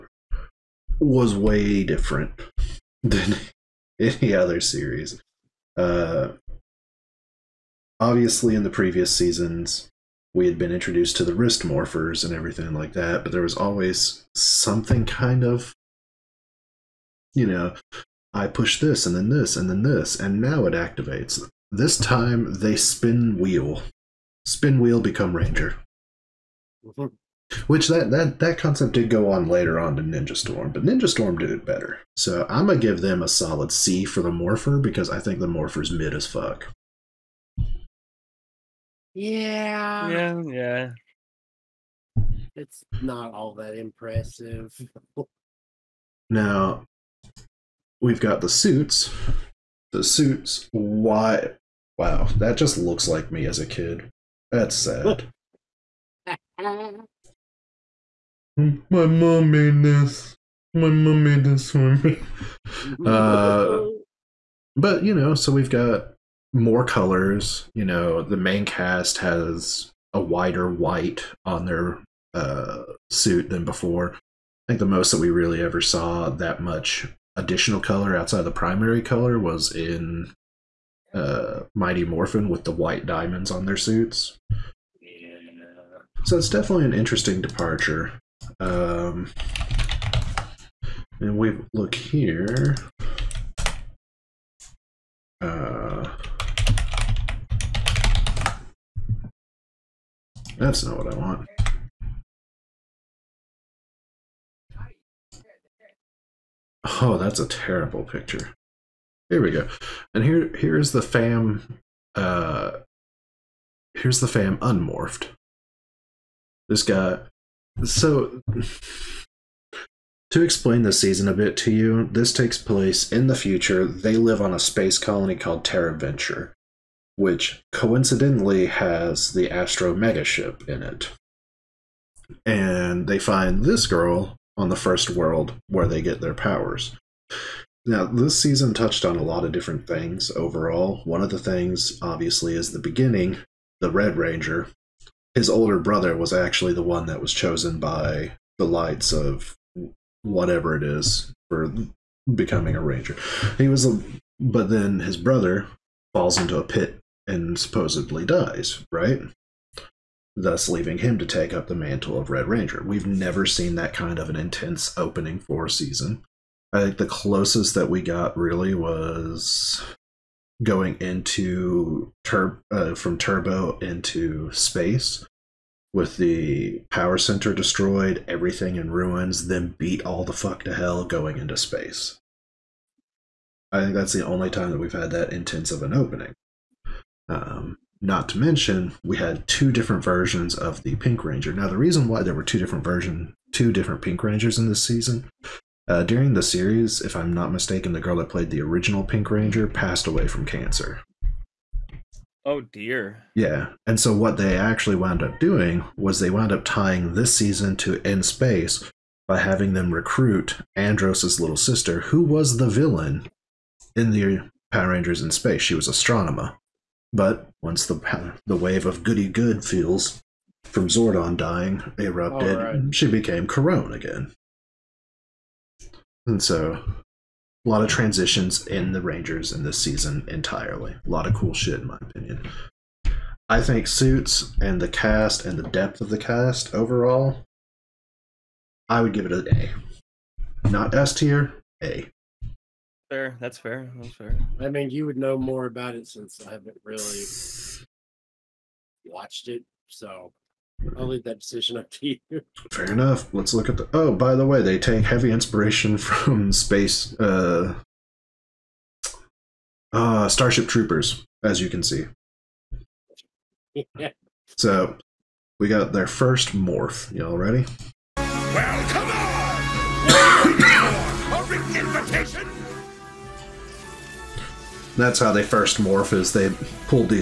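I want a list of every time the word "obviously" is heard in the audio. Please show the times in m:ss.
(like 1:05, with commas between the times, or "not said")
0:07, 2:21.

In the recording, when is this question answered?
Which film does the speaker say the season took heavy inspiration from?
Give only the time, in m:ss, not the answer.
4:20.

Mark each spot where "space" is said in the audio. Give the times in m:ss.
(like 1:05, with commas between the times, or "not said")
2:04, 2:54, 3:01, 3:28, 3:35, 4:16.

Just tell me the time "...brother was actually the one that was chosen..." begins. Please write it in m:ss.
2:25.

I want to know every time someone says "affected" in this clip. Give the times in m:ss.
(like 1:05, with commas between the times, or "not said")
not said.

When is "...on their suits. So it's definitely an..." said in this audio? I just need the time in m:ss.
1:23.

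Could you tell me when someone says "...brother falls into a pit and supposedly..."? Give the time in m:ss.
2:35.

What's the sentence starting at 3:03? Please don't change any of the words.
I think that's the only time that we've had that intense of an opening.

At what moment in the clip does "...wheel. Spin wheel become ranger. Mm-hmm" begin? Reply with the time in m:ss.
0:23.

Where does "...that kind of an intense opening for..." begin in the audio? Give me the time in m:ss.
2:43.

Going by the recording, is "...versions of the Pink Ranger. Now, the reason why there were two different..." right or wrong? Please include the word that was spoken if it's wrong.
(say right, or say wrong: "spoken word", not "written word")
right.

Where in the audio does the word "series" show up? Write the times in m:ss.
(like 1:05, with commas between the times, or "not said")
0:04, 3:16.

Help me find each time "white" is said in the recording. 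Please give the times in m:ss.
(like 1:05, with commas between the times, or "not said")
1:10, 1:22.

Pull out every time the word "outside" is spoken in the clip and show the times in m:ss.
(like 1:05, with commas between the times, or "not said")
1:18.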